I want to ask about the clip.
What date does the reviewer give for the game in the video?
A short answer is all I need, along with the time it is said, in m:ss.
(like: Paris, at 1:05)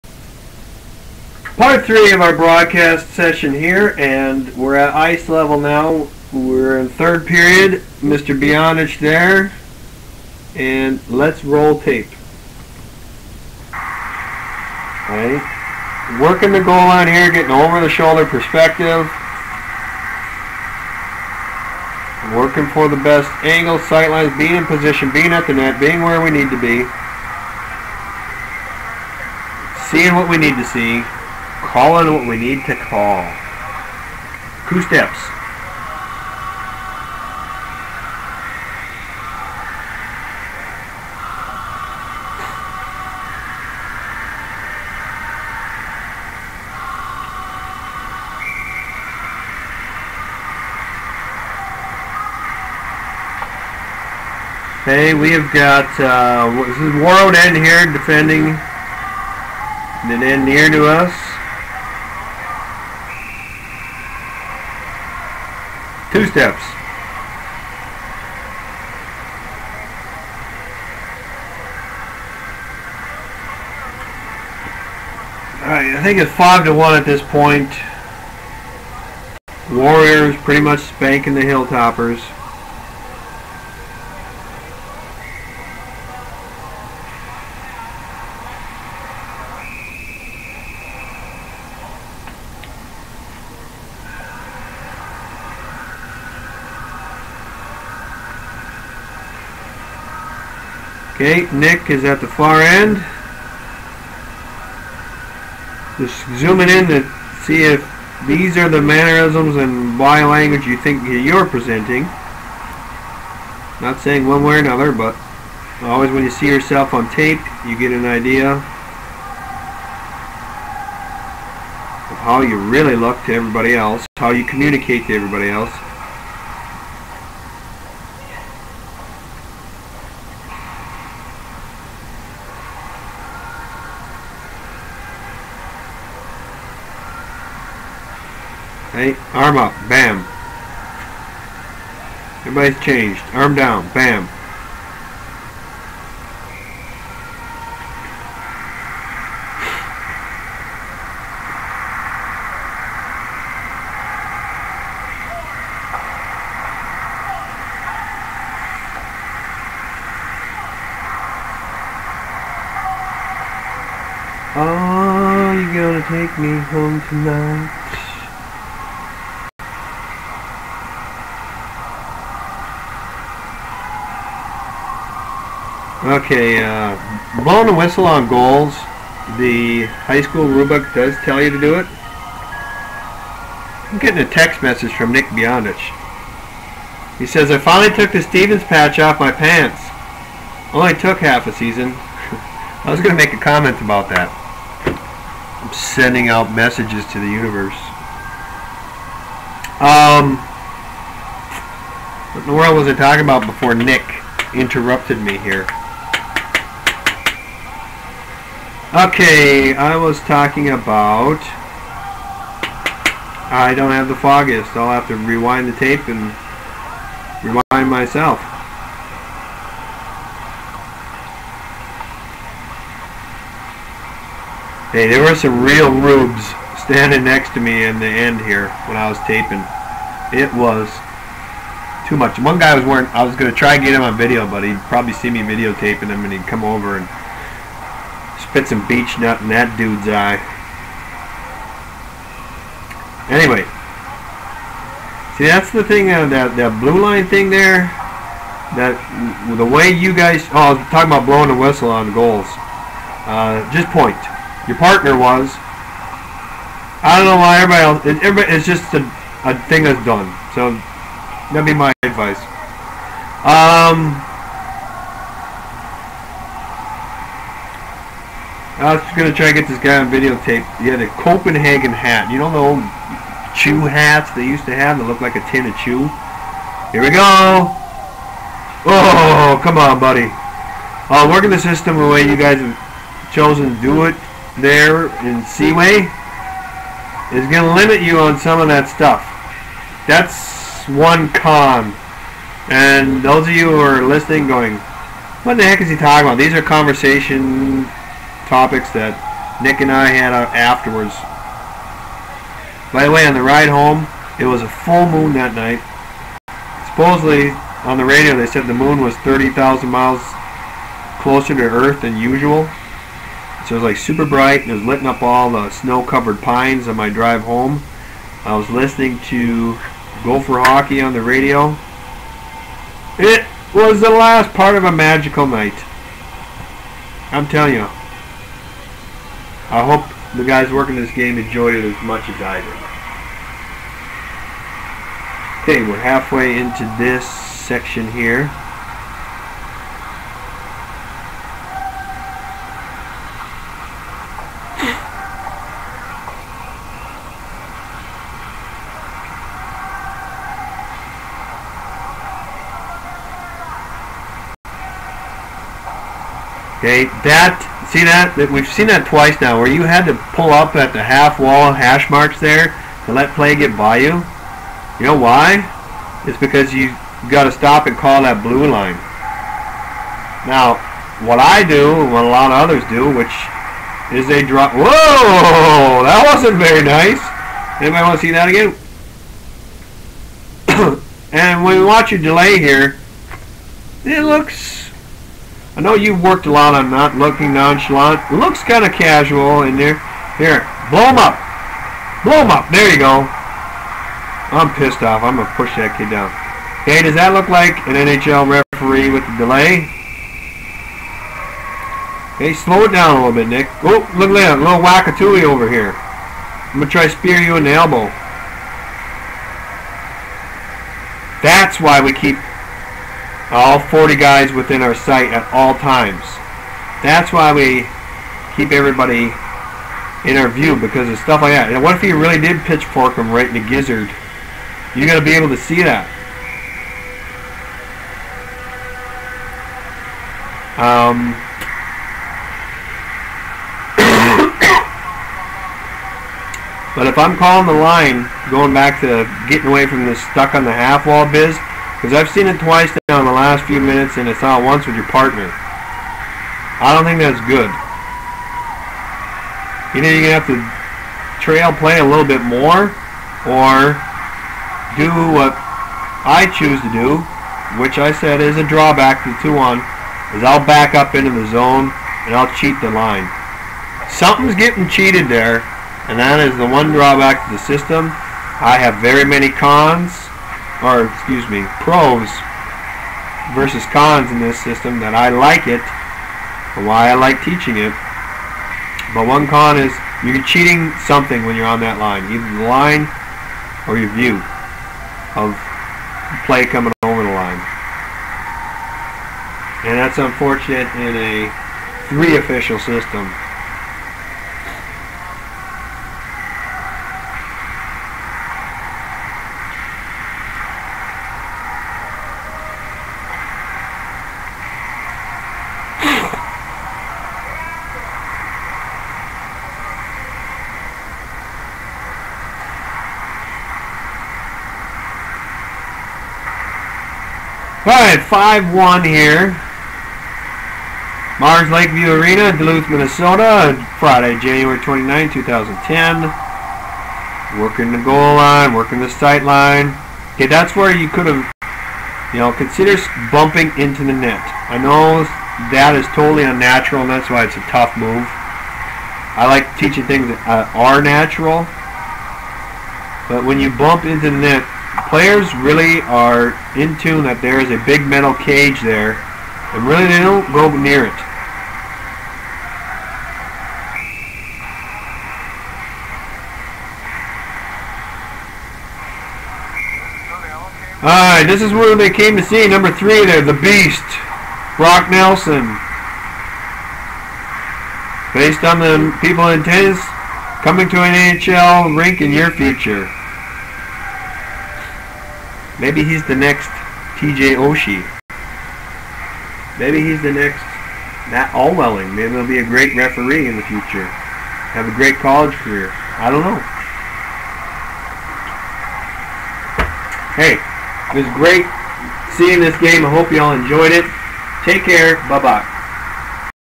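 January 29, 2010, at 8:44.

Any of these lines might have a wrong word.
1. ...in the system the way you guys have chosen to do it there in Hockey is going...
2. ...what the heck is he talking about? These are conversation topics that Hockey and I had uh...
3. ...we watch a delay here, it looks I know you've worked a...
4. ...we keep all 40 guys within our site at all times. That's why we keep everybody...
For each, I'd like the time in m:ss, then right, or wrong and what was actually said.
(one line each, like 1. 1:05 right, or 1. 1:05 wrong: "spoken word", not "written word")
1. 4:41 wrong: "Seaway", not "Hockey"
2. 4:55 wrong: "Nick", not "Hockey"
3. 6:21 right
4. 6:52 right.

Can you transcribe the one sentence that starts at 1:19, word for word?
Warriors pretty much spanking the Hilltoppers.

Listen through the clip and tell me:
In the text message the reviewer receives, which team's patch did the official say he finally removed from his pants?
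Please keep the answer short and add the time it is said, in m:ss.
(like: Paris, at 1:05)
Stevens, at 3:08.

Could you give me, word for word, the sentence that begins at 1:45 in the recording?
Just zooming in to see if these are the mannerisms and body language you think you're presenting.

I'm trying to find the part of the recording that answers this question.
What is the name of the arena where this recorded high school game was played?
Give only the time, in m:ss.
8:41.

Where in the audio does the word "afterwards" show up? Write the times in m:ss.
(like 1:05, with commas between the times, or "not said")
5:00.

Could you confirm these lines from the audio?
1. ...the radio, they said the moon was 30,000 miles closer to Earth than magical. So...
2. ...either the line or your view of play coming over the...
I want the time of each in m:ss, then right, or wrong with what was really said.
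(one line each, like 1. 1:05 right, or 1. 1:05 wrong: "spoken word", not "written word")
1. 5:07 wrong: "usual", not "magical"
2. 8:02 right.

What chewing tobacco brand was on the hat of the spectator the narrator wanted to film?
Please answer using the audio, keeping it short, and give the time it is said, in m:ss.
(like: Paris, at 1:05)
Copenhagen, at 4:31.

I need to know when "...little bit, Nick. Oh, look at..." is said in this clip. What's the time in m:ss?
6:43.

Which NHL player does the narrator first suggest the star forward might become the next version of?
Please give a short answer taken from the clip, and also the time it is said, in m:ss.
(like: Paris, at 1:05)
T.J. Oshie, at 9:37.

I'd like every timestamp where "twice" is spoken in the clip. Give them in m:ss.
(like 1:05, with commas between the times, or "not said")
5:59, 7:22.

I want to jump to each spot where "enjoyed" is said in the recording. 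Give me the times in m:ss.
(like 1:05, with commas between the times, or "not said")
5:31, 9:53.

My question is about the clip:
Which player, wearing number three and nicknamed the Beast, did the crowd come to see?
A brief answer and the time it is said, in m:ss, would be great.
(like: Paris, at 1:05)
Brock Nelson, at 9:24.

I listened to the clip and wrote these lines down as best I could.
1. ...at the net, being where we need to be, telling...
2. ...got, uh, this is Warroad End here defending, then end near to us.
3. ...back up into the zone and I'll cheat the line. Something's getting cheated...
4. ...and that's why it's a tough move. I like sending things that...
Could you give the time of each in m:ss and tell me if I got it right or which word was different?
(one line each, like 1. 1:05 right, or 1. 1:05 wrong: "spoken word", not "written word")
1. 0:25 wrong: "seeing", not "telling"
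2. 0:55 right
3. 7:40 right
4. 8:57 wrong: "teaching", not "sending".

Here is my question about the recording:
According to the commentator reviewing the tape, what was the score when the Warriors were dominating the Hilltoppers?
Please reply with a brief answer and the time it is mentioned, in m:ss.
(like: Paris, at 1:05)
5 to 1, at 1:16.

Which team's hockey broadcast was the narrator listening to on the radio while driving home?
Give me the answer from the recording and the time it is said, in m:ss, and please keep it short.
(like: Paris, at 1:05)
Gopher Hockey, at 5:20.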